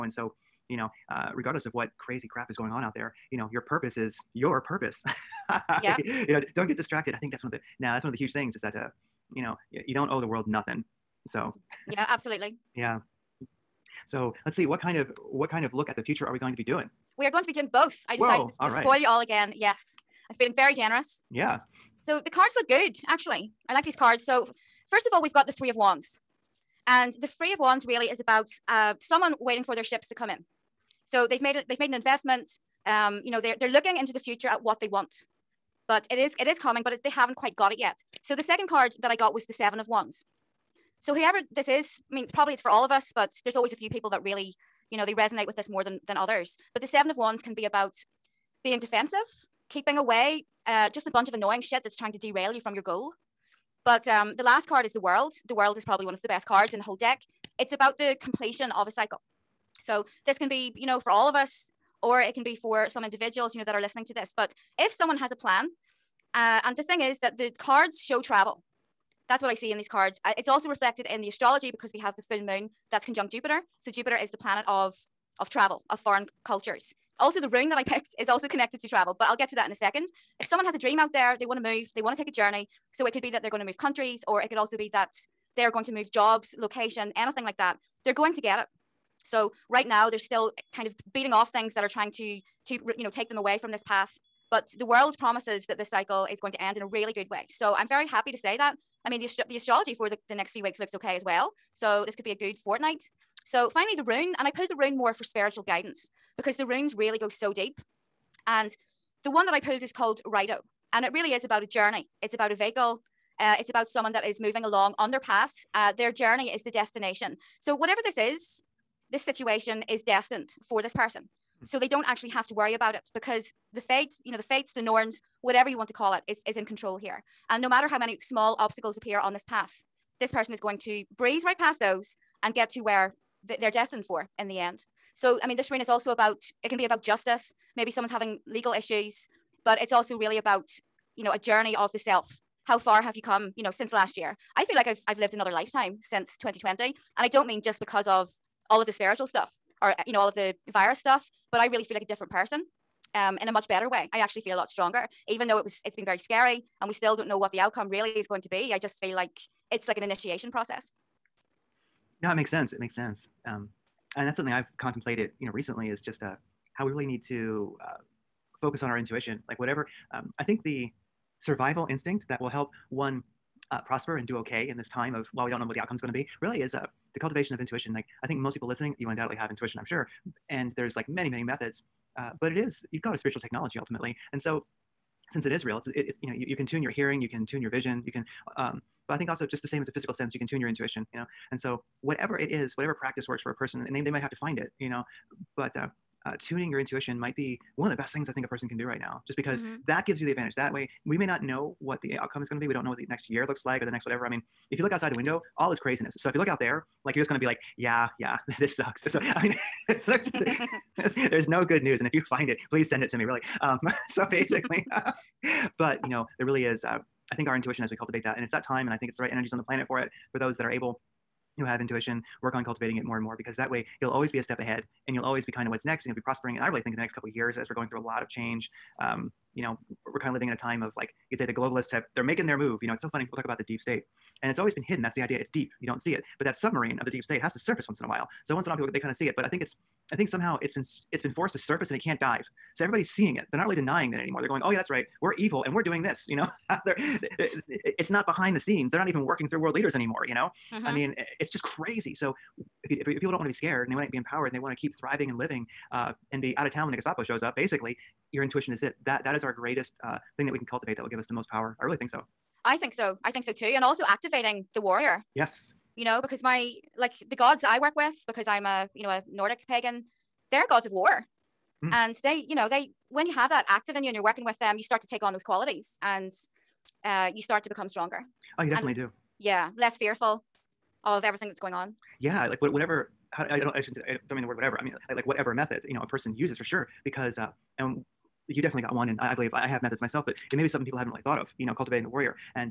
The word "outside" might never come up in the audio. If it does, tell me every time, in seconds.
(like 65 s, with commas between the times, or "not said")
204 s.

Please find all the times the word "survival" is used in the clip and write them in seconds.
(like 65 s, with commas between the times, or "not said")
171 s.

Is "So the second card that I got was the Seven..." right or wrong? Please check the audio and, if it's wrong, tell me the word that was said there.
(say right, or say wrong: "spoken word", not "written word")
right.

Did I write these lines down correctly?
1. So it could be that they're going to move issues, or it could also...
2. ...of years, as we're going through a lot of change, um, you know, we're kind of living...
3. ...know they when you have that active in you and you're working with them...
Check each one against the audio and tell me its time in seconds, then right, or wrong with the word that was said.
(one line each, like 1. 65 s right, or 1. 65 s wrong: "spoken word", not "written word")
1. 82 s wrong: "countries", not "issues"
2. 227 s right
3. 272 s right.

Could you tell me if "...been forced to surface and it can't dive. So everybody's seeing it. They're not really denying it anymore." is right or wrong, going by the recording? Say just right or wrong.
right.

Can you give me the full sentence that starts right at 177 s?
Like I think most people listening, you undoubtedly have intuition, I'm sure, and there's like many many methods.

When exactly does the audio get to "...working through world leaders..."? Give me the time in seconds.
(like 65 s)
249 s.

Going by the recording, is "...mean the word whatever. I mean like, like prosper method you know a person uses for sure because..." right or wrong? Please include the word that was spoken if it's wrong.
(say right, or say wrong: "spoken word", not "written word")
wrong: "whatever", not "prosper".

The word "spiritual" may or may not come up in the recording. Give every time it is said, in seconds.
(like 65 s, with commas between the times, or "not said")
105 s, 148 s, 183 s.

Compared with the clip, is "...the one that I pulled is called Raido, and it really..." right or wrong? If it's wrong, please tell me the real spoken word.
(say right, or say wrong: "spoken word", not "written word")
right.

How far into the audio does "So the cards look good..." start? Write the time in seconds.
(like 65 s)
22 s.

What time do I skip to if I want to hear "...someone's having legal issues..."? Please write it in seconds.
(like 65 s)
137 s.